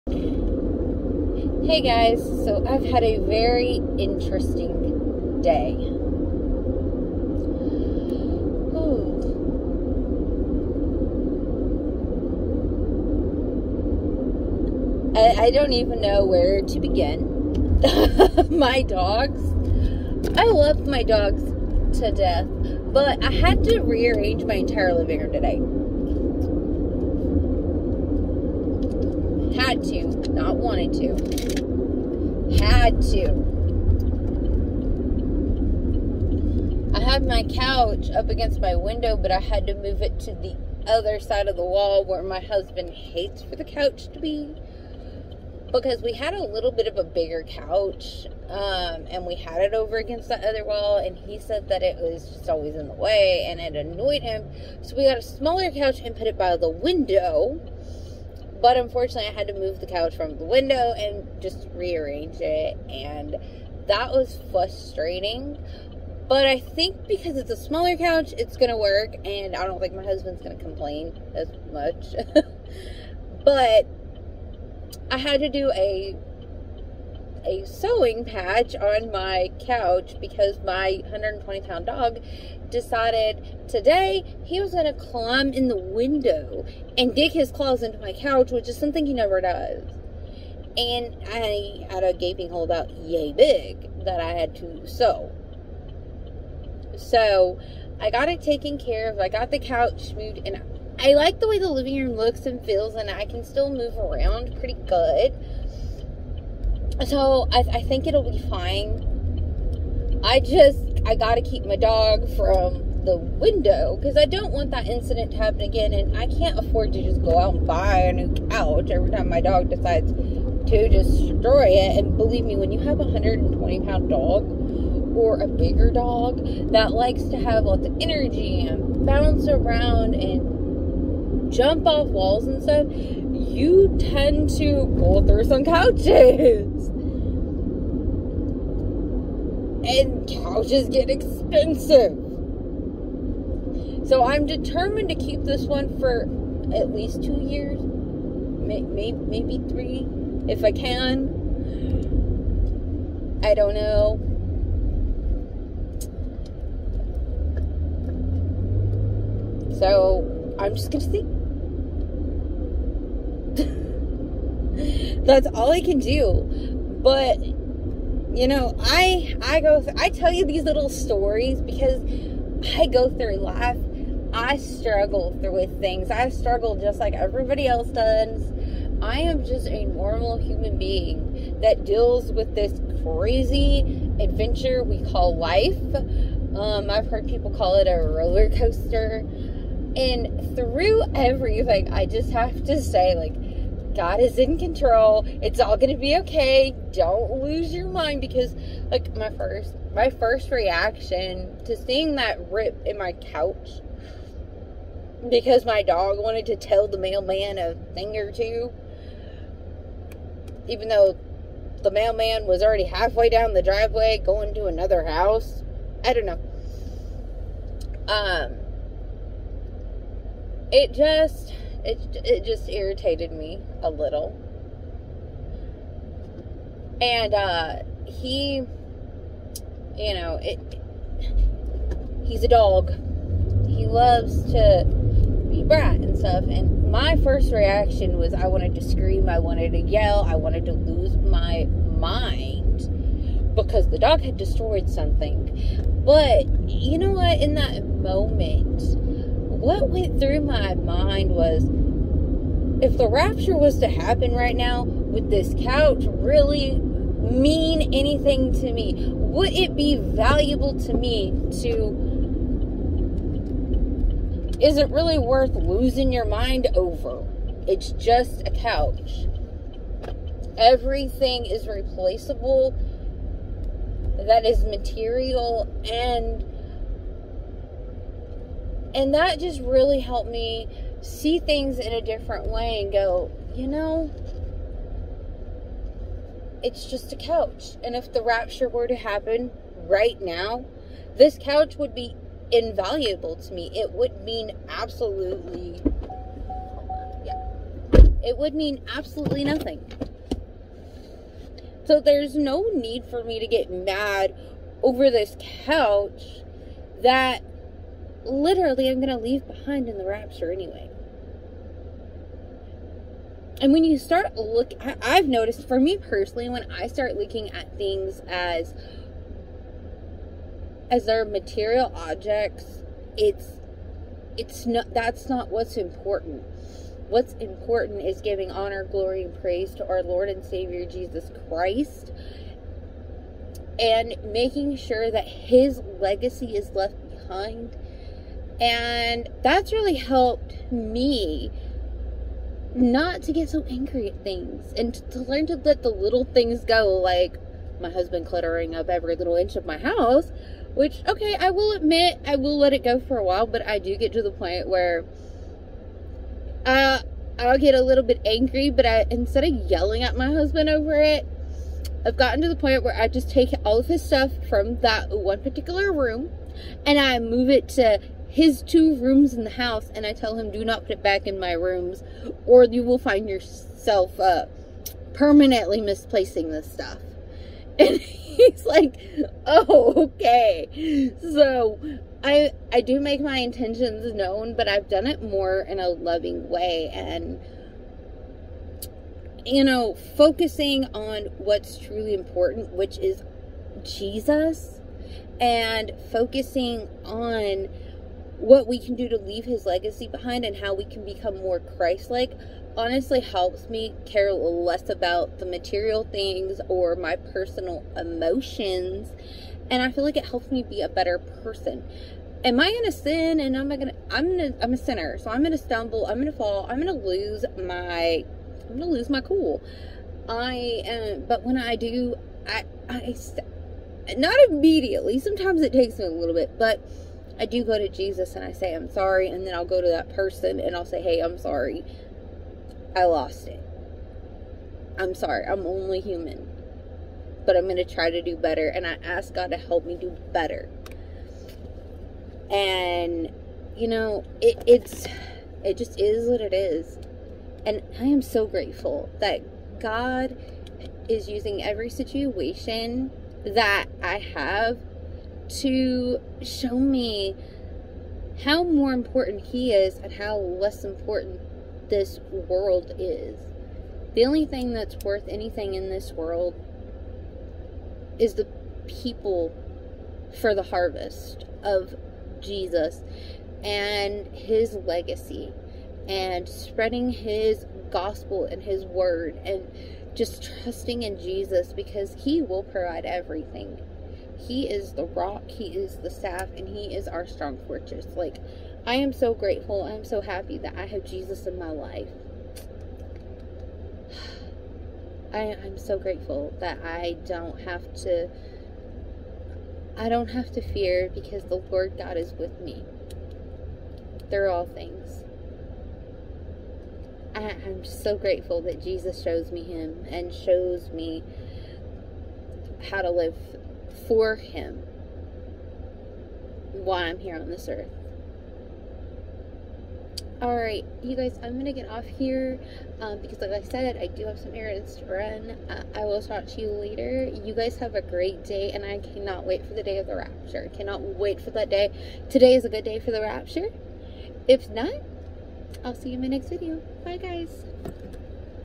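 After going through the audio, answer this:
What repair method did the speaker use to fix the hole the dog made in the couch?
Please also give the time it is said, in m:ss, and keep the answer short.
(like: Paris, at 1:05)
Sewing patch, at 1:17.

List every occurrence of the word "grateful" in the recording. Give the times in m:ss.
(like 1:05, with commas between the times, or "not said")
7:28, 8:09, 8:15, 8:28.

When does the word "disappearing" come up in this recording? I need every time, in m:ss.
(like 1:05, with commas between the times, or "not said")
not said.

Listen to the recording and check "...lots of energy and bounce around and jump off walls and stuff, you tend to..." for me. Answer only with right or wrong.
right.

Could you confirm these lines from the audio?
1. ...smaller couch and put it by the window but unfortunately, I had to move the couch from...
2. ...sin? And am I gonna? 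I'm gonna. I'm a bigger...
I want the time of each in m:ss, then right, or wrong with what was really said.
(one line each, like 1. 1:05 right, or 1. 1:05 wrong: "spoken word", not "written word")
1. 0:55 right
2. 6:52 wrong: "sinner", not "bigger".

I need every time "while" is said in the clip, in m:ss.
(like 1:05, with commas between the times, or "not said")
5:53, 8:36.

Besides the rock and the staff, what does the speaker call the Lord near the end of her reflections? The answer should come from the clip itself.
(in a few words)
Strong fortress.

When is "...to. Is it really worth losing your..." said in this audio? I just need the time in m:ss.
4:21.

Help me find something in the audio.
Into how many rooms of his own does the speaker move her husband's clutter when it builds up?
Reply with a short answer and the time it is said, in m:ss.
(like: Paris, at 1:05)
2, at 6:08.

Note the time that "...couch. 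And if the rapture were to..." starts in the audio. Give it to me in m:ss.
4:47.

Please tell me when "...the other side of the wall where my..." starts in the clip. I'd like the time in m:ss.
0:40.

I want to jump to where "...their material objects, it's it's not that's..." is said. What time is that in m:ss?
5:21.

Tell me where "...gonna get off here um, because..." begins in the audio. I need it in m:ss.
8:41.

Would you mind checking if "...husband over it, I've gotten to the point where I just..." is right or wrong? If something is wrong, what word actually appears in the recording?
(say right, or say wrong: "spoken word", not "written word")
right.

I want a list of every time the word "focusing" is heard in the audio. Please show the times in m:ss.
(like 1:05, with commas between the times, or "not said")
6:30, 6:36.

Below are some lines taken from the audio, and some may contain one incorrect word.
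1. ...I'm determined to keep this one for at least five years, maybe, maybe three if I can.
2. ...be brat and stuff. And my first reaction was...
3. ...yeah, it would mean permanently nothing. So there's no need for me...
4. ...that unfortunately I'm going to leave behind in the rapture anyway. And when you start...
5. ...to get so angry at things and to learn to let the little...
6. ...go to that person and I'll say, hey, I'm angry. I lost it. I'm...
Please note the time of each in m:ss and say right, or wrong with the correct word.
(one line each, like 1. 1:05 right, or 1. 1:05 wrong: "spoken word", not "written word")
1. 2:24 wrong: "two", not "five"
2. 3:55 right
3. 4:57 wrong: "absolutely", not "permanently"
4. 5:07 wrong: "literally", not "unfortunately"
5. 5:43 right
6. 7:09 wrong: "sorry", not "angry".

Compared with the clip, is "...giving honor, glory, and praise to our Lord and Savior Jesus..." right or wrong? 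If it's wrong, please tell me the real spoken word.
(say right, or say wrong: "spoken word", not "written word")
right.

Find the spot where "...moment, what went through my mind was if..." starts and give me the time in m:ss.
4:07.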